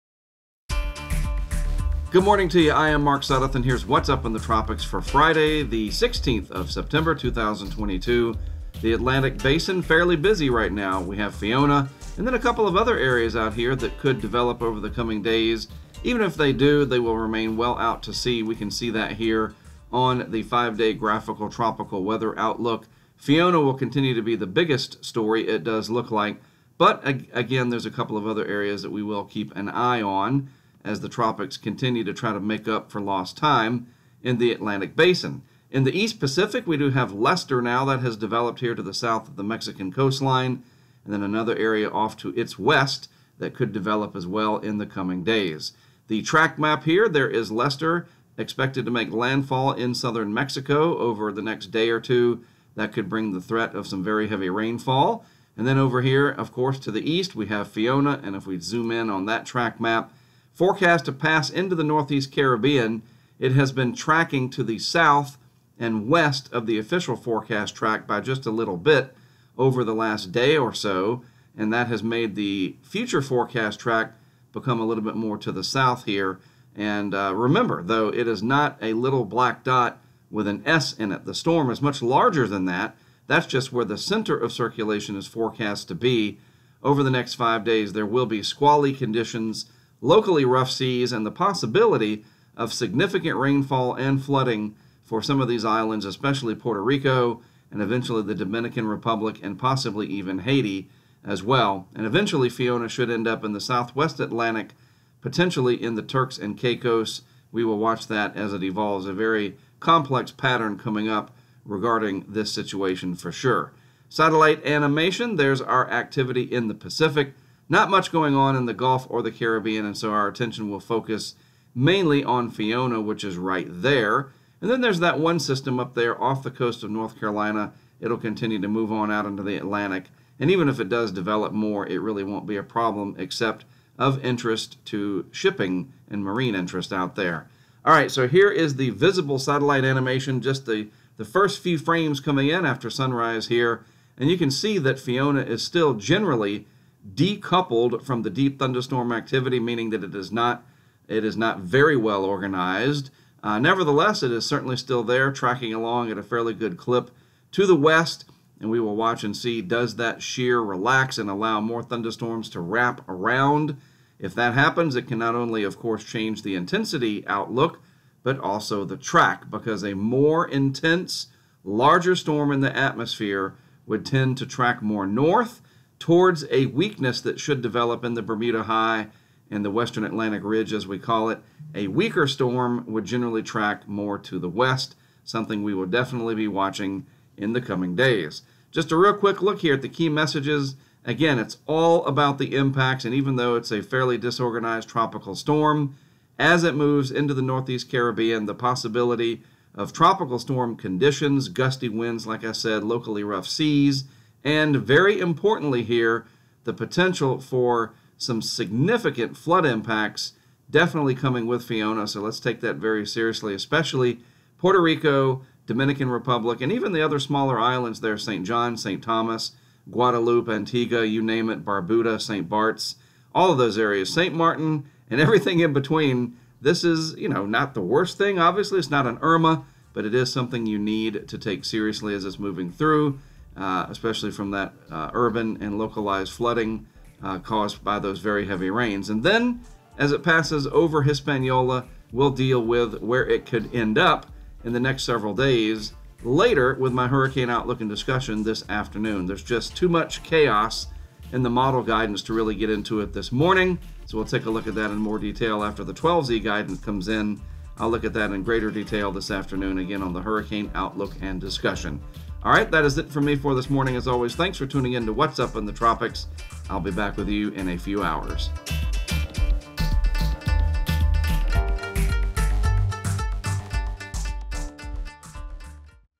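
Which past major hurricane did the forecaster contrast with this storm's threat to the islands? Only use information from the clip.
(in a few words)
Irma.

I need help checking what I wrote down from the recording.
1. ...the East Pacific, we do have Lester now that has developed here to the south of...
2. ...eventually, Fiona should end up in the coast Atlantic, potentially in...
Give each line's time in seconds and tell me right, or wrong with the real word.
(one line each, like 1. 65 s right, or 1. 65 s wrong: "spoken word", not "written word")
1. 35 s right
2. 102 s wrong: "southwest", not "coast".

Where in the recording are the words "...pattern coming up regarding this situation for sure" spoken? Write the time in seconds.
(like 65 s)
110 s.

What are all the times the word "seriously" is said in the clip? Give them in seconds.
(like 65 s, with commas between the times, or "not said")
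213 s, 231 s.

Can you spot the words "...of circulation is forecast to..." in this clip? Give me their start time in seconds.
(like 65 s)
84 s.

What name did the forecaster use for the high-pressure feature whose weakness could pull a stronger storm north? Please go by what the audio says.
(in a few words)
Western Atlantic Ridge.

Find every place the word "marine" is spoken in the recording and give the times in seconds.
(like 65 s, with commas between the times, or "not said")
136 s.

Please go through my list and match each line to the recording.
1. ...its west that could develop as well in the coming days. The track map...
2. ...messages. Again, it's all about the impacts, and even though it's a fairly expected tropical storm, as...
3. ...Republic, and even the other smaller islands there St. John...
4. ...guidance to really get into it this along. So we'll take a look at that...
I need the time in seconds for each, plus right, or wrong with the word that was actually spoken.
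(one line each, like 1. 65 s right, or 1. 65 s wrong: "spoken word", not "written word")
1. 42 s right
2. 190 s wrong: "disorganized", not "expected"
3. 216 s right
4. 251 s wrong: "morning", not "along".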